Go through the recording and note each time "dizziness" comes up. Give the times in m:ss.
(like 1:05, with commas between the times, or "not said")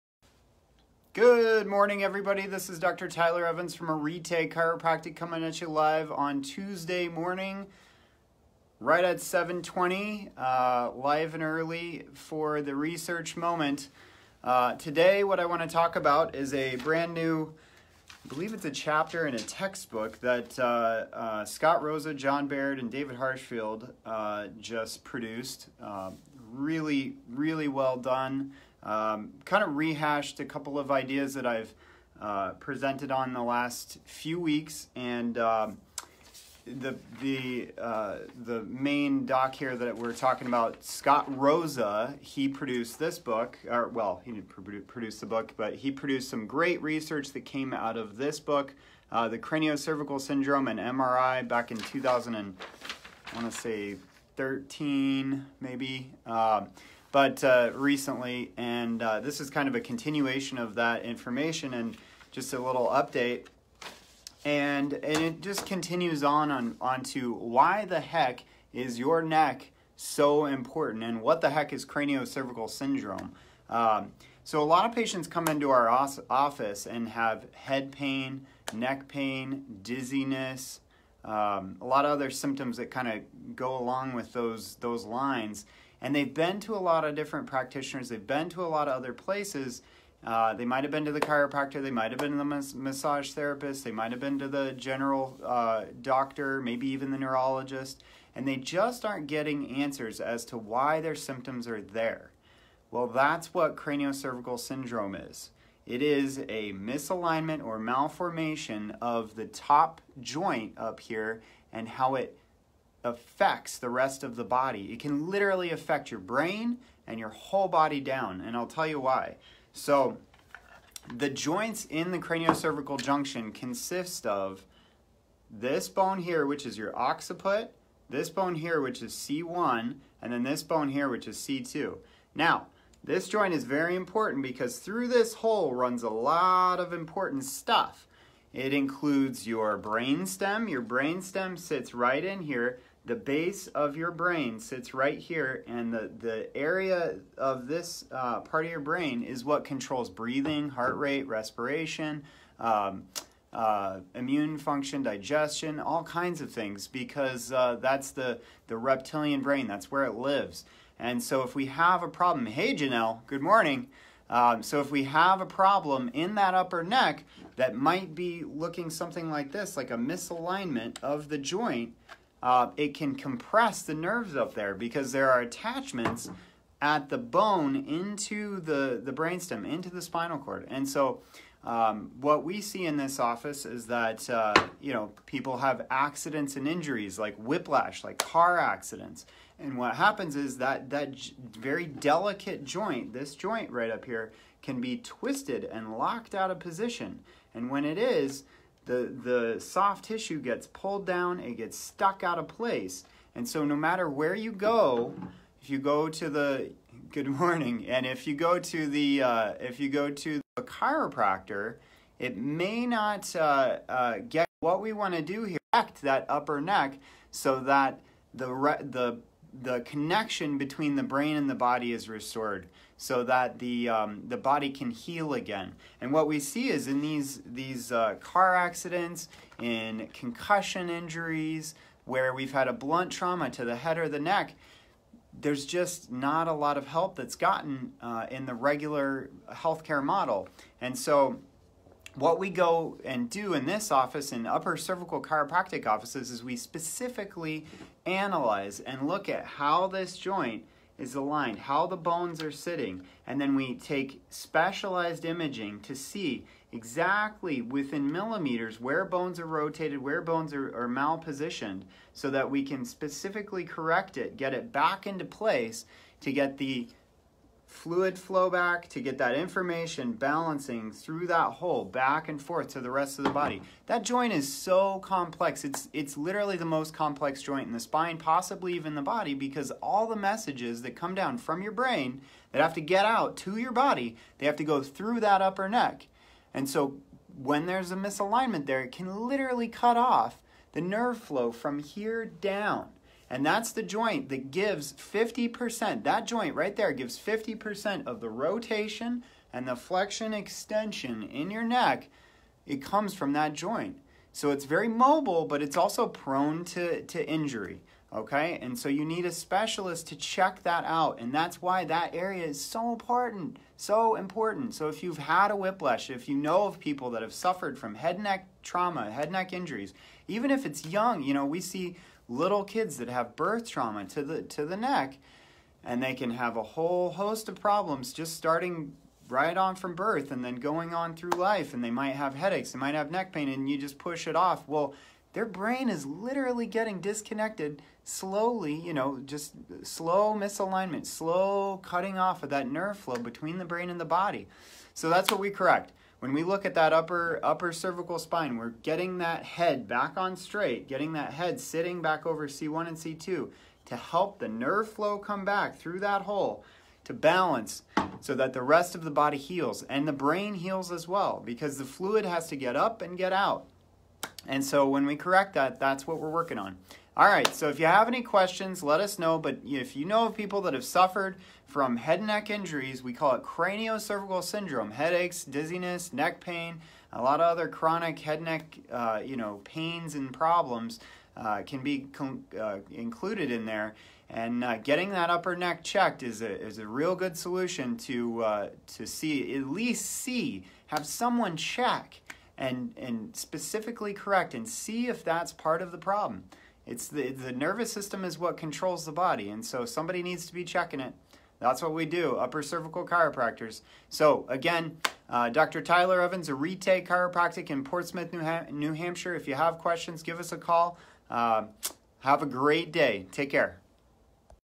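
1:19, 6:15.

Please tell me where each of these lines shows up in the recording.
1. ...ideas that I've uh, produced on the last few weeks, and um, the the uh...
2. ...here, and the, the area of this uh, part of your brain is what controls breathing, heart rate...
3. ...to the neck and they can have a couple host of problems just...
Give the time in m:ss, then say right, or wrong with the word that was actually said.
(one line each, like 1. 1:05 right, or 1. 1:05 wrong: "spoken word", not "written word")
1. 0:30 wrong: "presented", not "produced"
2. 2:25 right
3. 5:24 wrong: "whole", not "couple".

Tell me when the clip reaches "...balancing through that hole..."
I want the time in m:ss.
4:30.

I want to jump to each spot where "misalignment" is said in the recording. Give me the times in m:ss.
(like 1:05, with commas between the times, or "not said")
1:46, 2:49, 4:47, 5:40.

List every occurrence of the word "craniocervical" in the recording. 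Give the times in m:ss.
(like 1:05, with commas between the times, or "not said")
0:49, 1:11, 1:43, 2:02, 6:13.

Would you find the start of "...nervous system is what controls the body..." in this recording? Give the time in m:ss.
6:37.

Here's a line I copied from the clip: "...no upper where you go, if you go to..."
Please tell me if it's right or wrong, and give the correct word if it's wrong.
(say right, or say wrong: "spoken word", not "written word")
wrong: "matter", not "upper".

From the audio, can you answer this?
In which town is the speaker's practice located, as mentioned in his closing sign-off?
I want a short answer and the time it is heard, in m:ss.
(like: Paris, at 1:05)
Portsmouth, at 6:47.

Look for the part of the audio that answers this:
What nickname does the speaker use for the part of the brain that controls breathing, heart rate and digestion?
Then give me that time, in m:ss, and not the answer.
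2:38.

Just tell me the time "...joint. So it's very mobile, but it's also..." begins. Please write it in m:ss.
5:03.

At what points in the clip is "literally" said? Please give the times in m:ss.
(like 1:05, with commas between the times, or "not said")
1:55, 4:36, 4:49, 5:36.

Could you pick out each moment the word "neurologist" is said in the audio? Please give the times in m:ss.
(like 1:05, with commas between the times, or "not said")
1:37.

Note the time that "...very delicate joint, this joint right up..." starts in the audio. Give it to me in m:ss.
3:11.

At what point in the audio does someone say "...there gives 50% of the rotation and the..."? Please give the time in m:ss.
4:56.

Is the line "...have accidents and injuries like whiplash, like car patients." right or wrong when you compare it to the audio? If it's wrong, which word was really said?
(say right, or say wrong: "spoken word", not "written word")
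wrong: "accidents", not "patients".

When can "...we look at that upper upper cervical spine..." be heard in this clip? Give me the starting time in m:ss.
5:46.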